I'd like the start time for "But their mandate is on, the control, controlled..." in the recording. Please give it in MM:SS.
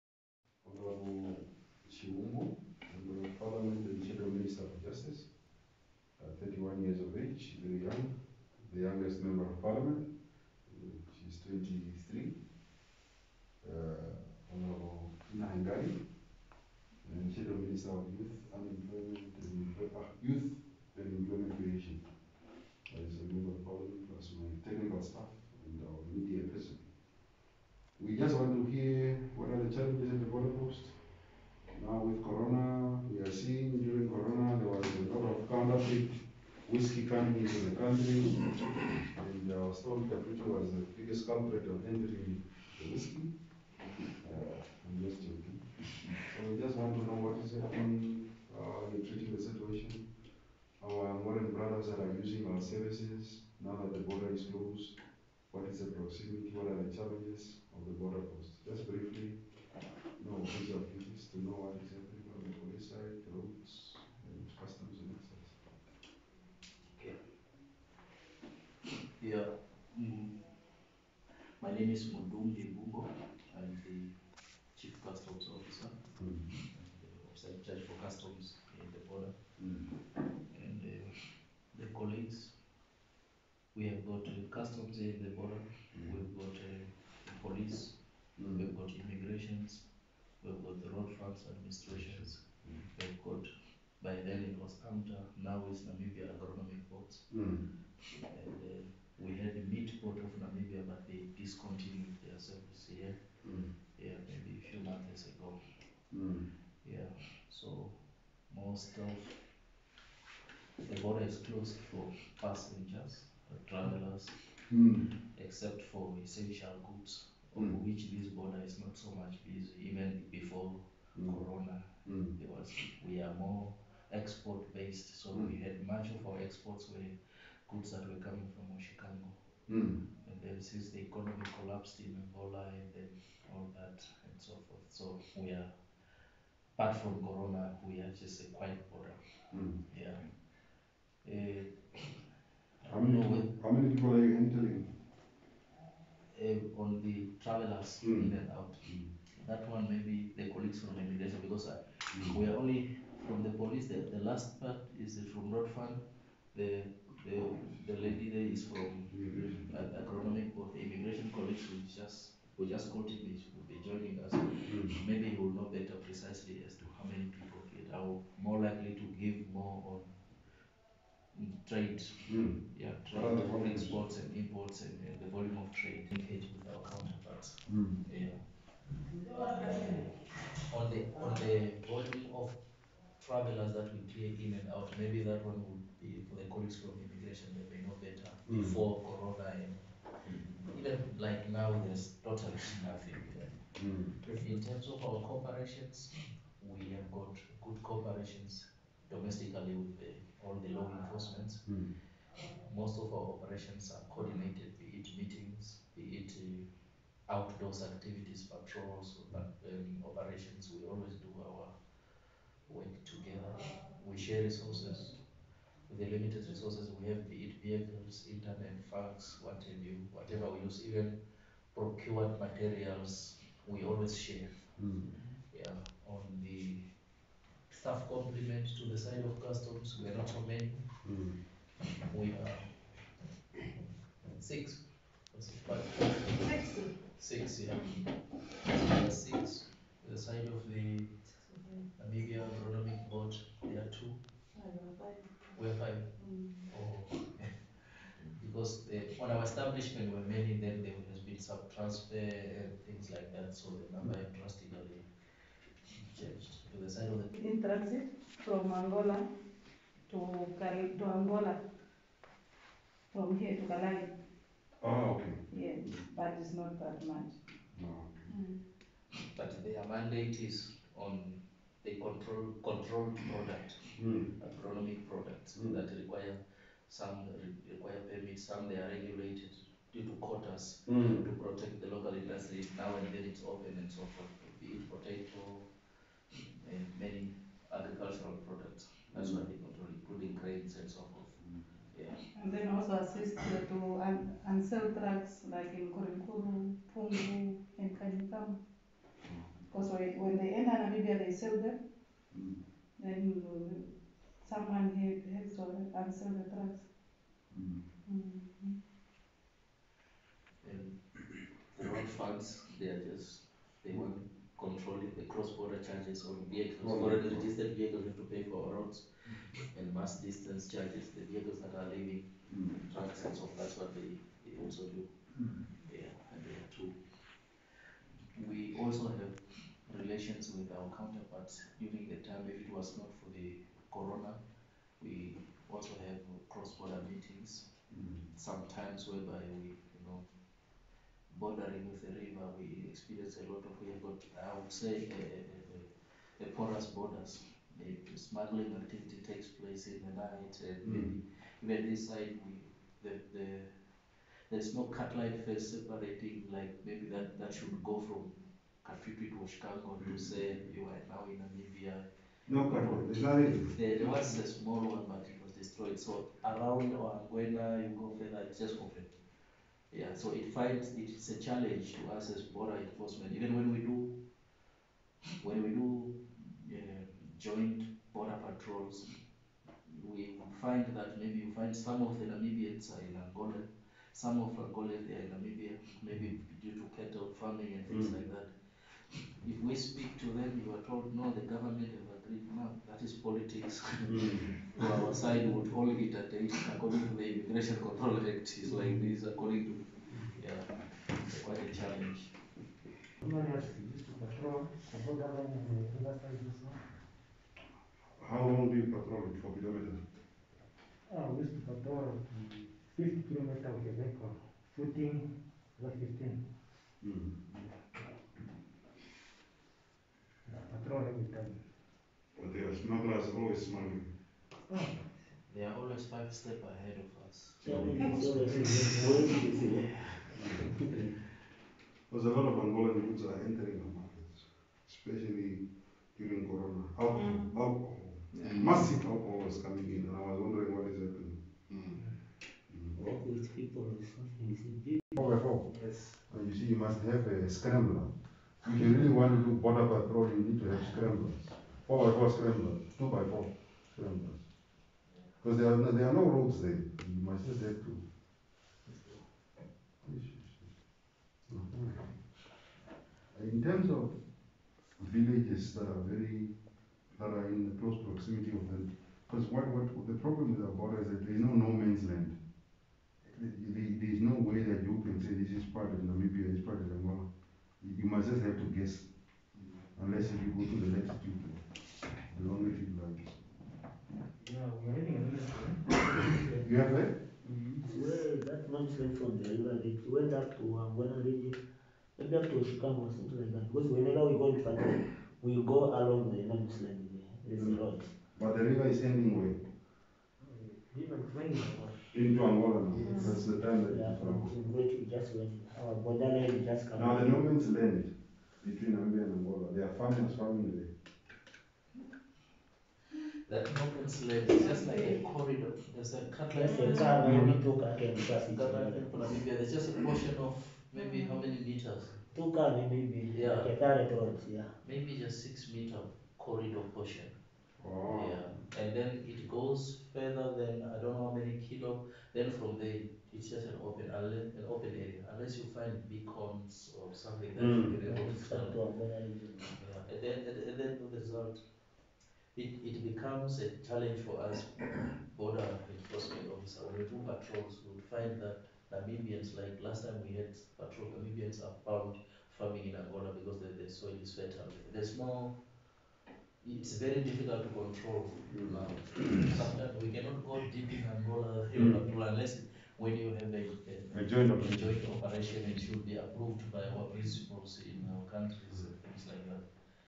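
04:29.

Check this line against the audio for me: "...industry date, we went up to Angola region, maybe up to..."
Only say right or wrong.
wrong.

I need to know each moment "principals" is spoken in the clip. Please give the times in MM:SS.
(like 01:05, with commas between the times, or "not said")
09:27.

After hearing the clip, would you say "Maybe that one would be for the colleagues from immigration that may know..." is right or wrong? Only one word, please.
right.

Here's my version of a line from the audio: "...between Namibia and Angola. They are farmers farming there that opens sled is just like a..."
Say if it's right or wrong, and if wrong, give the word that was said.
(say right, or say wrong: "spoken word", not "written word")
right.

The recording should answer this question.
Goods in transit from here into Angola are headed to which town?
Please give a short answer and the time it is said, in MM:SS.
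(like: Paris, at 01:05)
Calai, at 04:23.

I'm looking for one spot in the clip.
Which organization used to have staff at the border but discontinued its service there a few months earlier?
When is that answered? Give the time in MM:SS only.
01:39.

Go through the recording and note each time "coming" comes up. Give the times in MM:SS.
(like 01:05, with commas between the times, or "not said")
02:08, 07:19.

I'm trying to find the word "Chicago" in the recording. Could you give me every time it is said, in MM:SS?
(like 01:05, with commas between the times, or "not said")
05:59, 08:12.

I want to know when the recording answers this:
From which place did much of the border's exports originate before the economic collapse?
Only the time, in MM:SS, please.
02:08.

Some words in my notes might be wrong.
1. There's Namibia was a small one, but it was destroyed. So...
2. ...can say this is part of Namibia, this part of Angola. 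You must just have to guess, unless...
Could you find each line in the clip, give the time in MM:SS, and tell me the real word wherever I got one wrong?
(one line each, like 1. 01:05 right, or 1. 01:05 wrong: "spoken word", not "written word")
1. 06:03 wrong: "There", not "Namibia"
2. 07:55 right.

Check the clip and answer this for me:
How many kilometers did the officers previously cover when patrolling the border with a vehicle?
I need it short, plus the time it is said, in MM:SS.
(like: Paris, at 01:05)
50, at 06:52.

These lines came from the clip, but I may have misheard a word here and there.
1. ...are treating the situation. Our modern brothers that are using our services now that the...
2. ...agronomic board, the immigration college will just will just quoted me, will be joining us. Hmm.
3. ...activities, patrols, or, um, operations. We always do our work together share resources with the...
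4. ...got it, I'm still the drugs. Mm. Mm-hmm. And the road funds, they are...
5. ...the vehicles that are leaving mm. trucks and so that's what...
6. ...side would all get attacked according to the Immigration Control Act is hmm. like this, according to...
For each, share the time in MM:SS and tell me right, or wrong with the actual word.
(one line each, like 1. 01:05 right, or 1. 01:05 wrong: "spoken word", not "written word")
1. 00:48 right
2. 02:39 right
3. 03:27 right
4. 05:05 right
5. 05:21 right
6. 06:35 right.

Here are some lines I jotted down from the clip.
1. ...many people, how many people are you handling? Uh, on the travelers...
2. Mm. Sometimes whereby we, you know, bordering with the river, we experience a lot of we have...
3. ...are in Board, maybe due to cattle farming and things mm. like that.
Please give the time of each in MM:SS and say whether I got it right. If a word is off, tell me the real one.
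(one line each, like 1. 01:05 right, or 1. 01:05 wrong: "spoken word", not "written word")
1. 02:22 right
2. 05:37 right
3. 06:25 wrong: "Namibia", not "Board".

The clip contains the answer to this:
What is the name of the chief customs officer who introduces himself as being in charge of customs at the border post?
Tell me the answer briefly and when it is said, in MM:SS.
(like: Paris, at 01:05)
Mudum Bimbo, at 01:12.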